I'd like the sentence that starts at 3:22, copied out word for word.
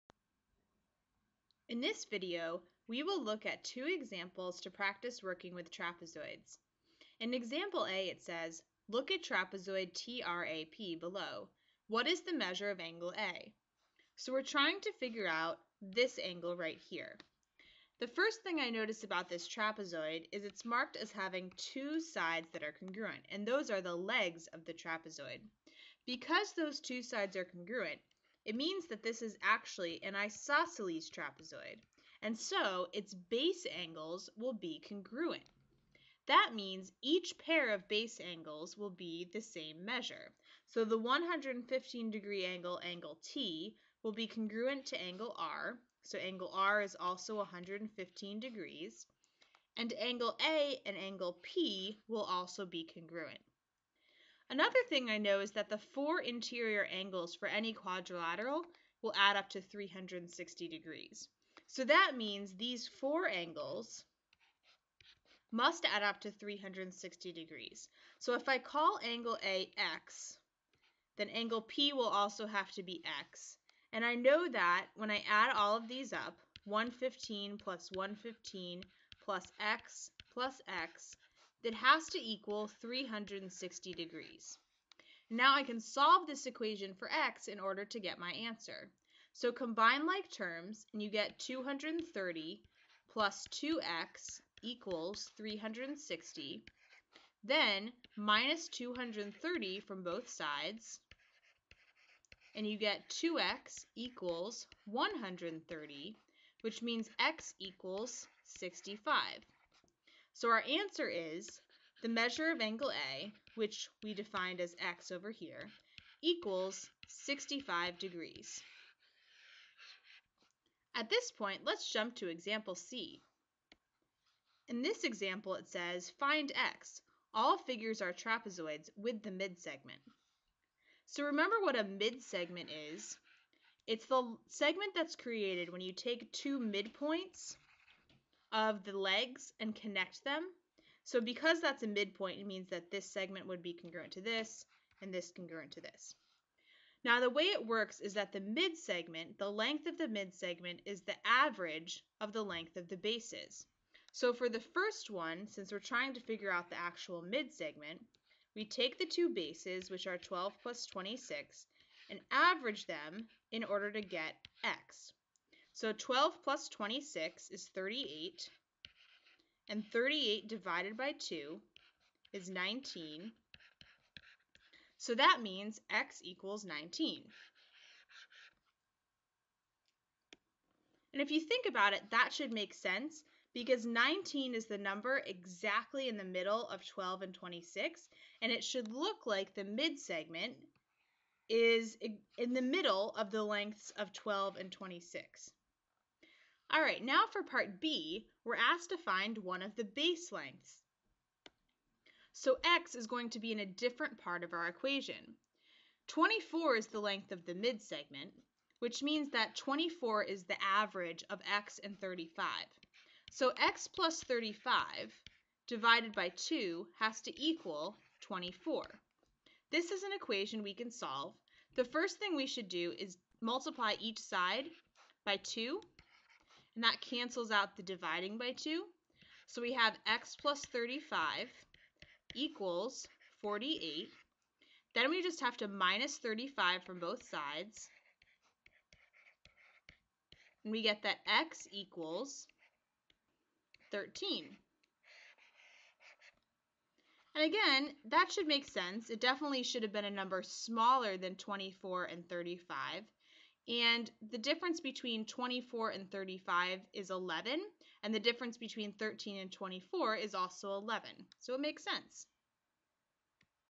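So x is going to be in a different part of our equation.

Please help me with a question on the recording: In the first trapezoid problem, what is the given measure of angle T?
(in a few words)
115 degrees.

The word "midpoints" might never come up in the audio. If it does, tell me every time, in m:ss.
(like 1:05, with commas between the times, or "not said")
2:16, 2:21.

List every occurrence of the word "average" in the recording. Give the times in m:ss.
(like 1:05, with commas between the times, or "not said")
2:31, 2:42, 3:30.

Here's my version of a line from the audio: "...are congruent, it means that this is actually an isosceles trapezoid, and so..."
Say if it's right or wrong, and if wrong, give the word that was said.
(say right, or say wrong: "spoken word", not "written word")
right.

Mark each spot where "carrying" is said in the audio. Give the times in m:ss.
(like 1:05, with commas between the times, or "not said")
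not said.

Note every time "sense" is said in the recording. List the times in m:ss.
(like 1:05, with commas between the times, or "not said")
3:02, 4:08, 4:21.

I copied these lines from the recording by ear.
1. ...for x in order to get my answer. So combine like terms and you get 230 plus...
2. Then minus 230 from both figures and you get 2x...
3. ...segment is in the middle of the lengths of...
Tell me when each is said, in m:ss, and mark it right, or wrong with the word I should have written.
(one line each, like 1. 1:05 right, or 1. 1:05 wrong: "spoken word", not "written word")
1. 1:26 right
2. 1:37 wrong: "sides", not "figures"
3. 3:09 right.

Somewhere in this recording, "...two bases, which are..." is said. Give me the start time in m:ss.
2:39.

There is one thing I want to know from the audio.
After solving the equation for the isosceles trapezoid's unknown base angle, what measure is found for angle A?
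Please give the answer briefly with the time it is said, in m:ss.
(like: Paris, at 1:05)
65 degrees, at 1:57.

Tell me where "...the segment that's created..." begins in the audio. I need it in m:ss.
2:14.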